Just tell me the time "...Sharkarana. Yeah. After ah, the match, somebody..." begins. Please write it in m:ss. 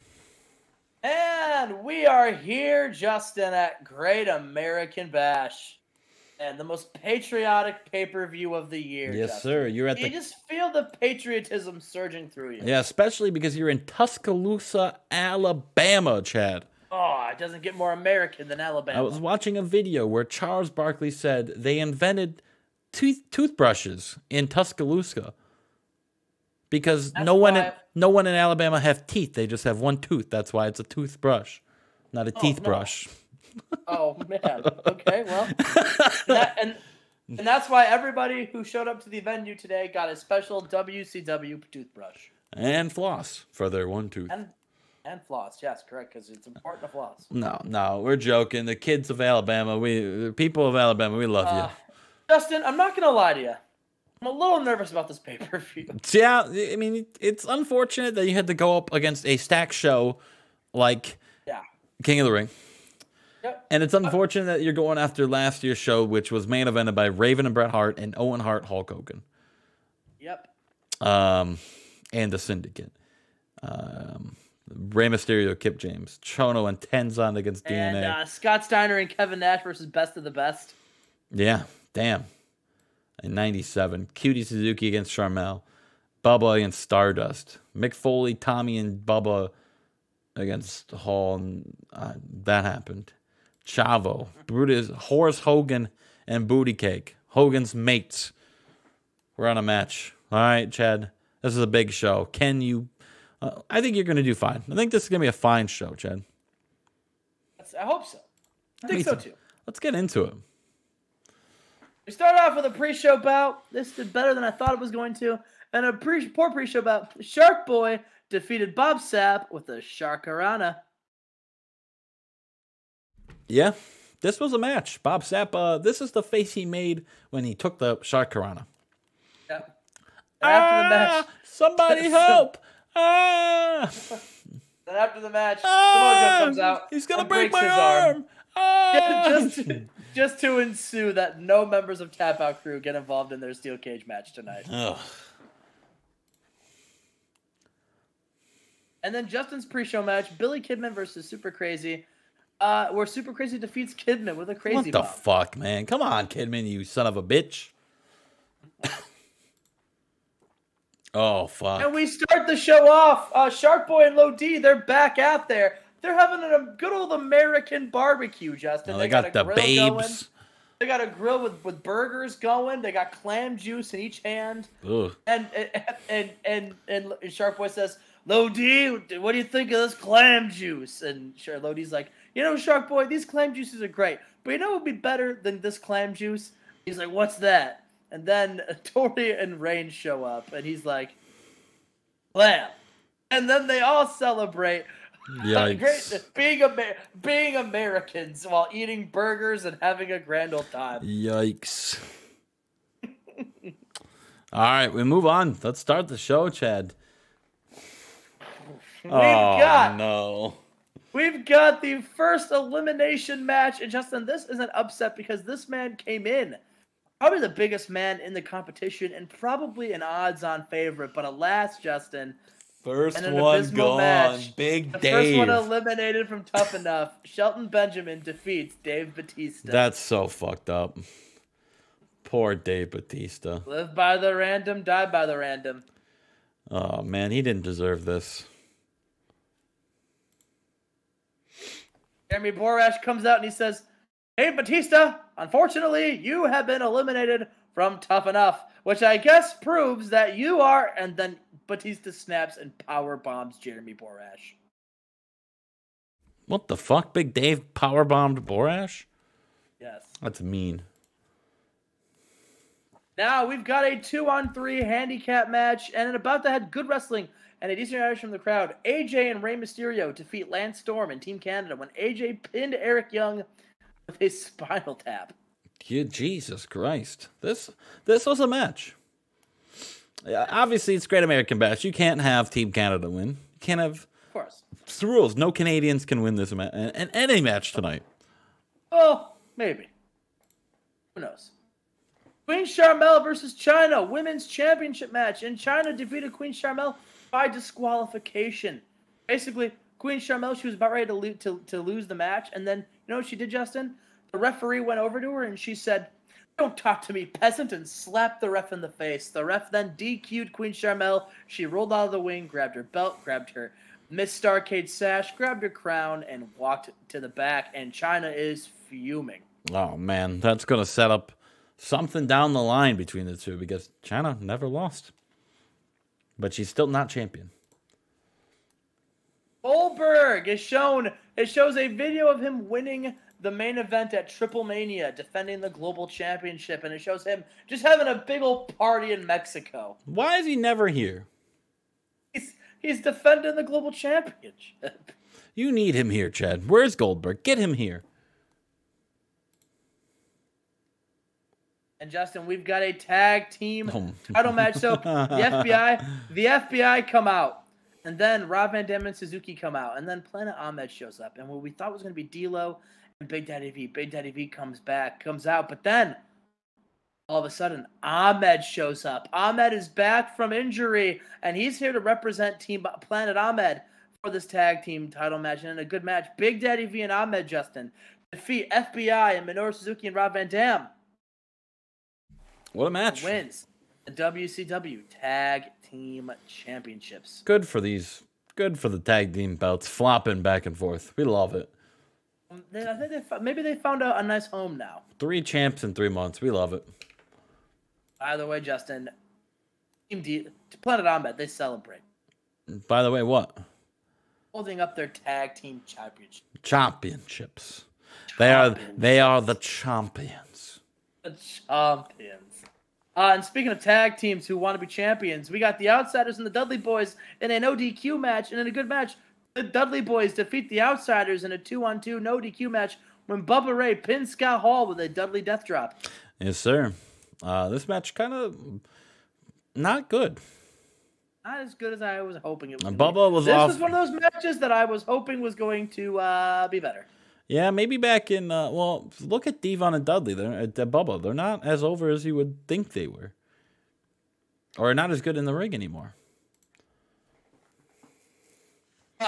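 2:07.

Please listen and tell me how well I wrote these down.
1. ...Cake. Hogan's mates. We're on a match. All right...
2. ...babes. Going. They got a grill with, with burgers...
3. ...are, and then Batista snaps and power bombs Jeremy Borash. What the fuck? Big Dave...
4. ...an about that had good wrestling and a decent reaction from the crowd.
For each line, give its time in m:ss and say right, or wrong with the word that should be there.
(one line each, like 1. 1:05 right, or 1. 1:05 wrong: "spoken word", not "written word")
1. 1:36 right
2. 2:49 right
3. 4:10 right
4. 4:26 right.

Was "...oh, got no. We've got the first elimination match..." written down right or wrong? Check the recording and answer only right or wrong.
right.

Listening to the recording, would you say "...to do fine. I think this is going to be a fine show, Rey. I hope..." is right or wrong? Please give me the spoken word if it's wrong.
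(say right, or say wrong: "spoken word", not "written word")
wrong: "Chad", not "Rey".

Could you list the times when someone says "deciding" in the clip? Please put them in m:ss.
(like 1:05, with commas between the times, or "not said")
not said.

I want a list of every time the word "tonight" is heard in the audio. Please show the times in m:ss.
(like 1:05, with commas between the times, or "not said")
2:24, 4:47.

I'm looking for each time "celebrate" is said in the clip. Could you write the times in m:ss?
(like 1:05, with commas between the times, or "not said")
3:14, 6:41.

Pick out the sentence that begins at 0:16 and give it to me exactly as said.
Oh, it doesn't get more American than Alabama.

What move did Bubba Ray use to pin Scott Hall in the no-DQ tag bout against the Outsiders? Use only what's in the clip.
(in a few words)
Dudley death drop.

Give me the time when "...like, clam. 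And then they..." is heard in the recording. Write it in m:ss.
3:10.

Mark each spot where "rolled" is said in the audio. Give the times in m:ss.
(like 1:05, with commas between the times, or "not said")
5:11.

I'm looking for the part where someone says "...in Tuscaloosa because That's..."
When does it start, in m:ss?
0:24.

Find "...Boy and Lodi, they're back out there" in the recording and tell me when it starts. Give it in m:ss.
2:43.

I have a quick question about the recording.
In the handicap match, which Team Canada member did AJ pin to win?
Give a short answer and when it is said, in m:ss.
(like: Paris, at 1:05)
Eric Young, at 4:32.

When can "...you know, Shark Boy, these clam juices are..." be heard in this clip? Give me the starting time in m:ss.
3:02.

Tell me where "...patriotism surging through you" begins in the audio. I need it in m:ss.
0:10.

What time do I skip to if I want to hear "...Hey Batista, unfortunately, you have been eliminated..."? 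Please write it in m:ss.
4:04.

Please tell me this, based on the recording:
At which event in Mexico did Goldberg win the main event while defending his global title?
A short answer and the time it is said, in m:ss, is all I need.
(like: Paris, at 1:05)
Triple Mania, at 5:34.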